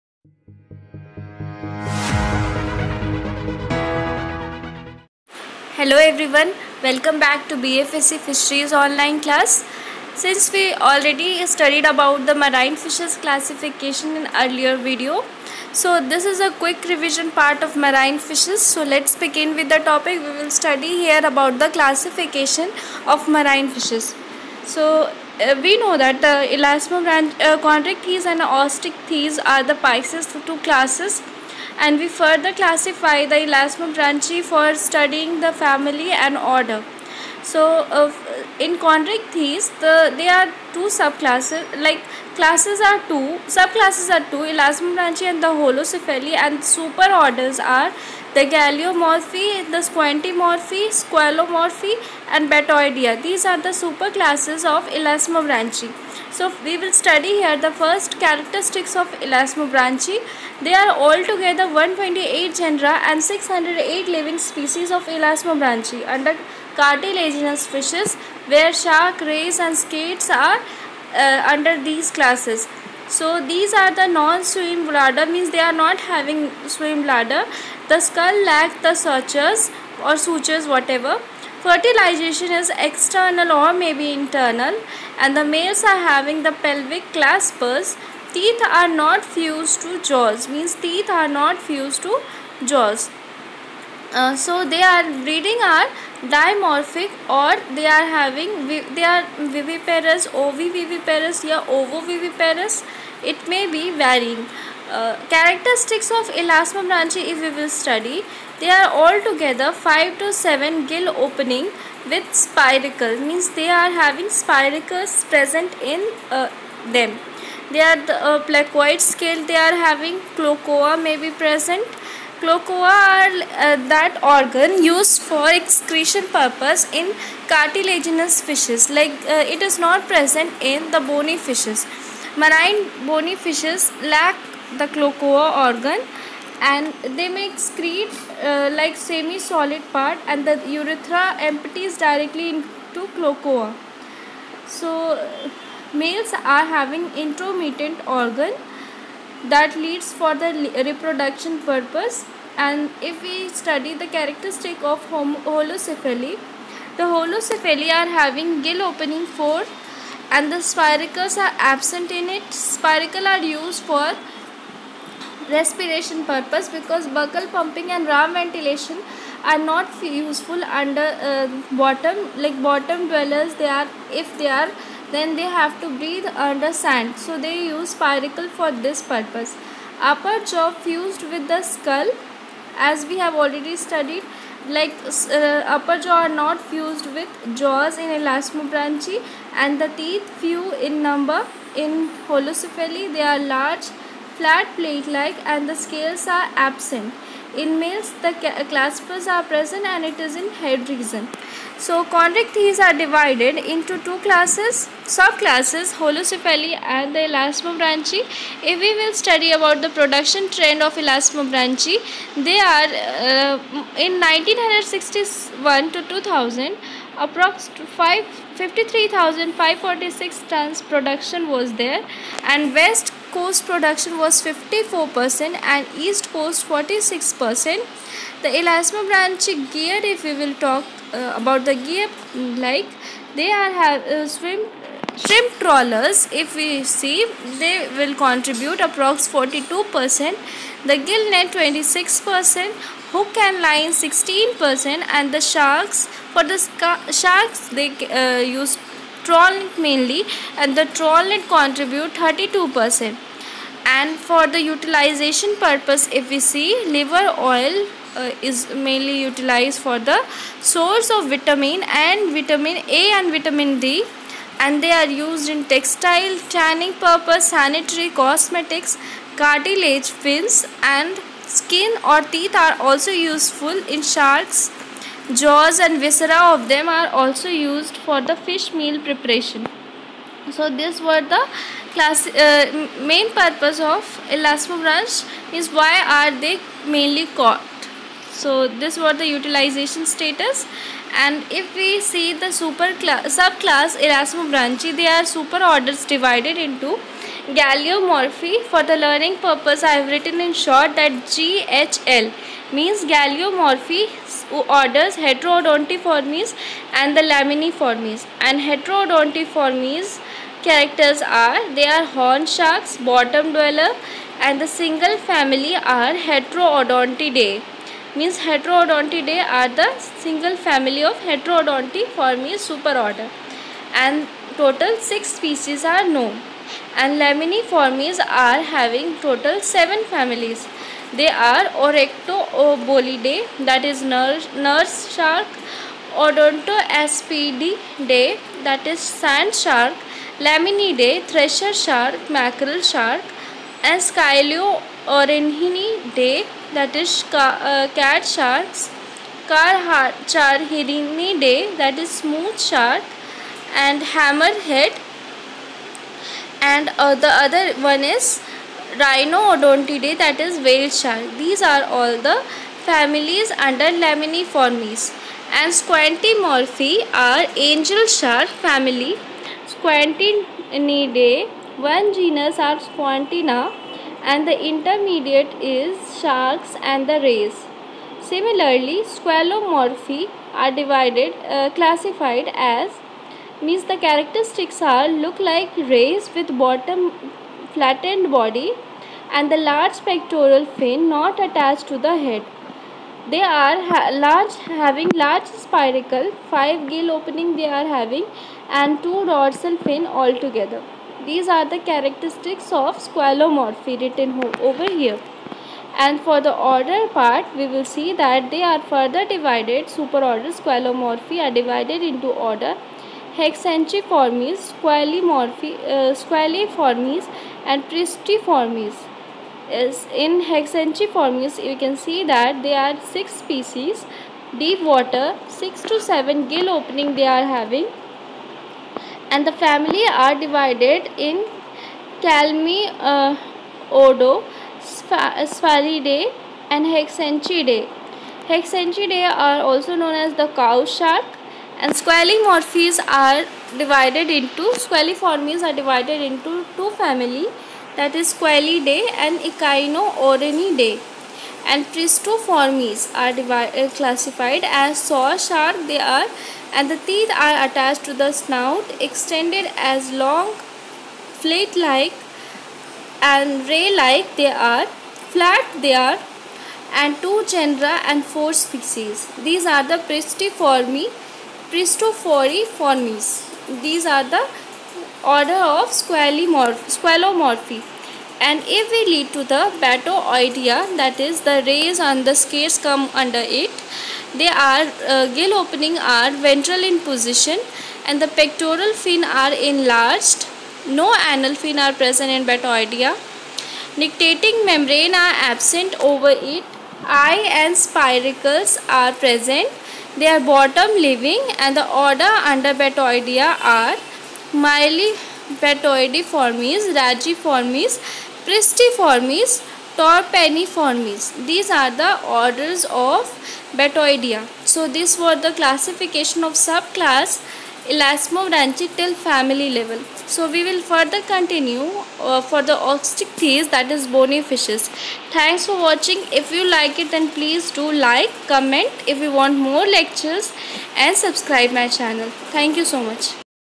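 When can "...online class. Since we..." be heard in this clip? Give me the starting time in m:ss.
0:08.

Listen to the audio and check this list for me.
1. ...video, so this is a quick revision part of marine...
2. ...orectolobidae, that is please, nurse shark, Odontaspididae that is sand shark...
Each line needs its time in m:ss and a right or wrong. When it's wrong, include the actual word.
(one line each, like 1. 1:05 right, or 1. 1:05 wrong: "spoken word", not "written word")
1. 0:14 right
2. 5:31 wrong: "nurse", not "please".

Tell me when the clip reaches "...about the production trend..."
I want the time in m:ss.
3:29.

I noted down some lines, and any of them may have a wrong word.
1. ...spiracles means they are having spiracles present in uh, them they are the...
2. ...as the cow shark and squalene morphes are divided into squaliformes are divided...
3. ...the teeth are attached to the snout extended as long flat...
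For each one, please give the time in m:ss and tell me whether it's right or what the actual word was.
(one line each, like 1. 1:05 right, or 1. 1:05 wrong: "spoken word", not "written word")
1. 1:52 right
2. 7:20 right
3. 7:36 right.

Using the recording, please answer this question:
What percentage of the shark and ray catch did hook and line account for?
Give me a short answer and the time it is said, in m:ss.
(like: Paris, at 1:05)
16%, at 4:03.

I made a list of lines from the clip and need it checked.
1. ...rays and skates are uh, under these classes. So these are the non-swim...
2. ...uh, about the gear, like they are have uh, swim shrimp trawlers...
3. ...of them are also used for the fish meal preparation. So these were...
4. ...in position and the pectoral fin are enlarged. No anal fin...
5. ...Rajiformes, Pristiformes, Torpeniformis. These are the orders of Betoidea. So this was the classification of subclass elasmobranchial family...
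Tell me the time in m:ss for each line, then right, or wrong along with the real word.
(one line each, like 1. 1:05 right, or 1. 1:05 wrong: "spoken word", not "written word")
1. 1:09 right
2. 3:51 right
3. 4:36 right
4. 8:06 right
5. 8:26 right.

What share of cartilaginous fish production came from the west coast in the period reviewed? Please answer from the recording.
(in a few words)
54%.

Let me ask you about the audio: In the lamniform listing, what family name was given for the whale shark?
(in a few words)
Rhinodontidae.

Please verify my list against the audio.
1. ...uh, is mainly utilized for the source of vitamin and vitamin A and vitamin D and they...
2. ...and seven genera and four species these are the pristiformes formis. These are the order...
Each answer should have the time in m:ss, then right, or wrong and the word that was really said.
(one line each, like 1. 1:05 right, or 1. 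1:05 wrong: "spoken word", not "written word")
1. 4:18 right
2. 7:47 wrong: "two", not "seven".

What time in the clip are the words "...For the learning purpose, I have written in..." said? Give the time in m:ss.
4:58.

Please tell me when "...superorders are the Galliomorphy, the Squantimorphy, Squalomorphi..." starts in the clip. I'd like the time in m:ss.
0:46.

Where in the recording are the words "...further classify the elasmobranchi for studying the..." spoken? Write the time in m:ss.
0:32.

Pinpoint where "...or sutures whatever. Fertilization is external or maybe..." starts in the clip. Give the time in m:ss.
1:20.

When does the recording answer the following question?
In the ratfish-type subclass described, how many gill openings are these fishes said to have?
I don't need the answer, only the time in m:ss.
2:39.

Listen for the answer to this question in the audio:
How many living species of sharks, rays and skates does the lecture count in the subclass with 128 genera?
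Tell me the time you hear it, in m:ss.
1:03.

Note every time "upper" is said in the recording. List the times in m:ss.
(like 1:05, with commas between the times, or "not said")
3:00, 3:05.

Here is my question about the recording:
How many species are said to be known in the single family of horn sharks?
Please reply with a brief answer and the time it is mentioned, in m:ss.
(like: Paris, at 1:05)
6, at 5:24.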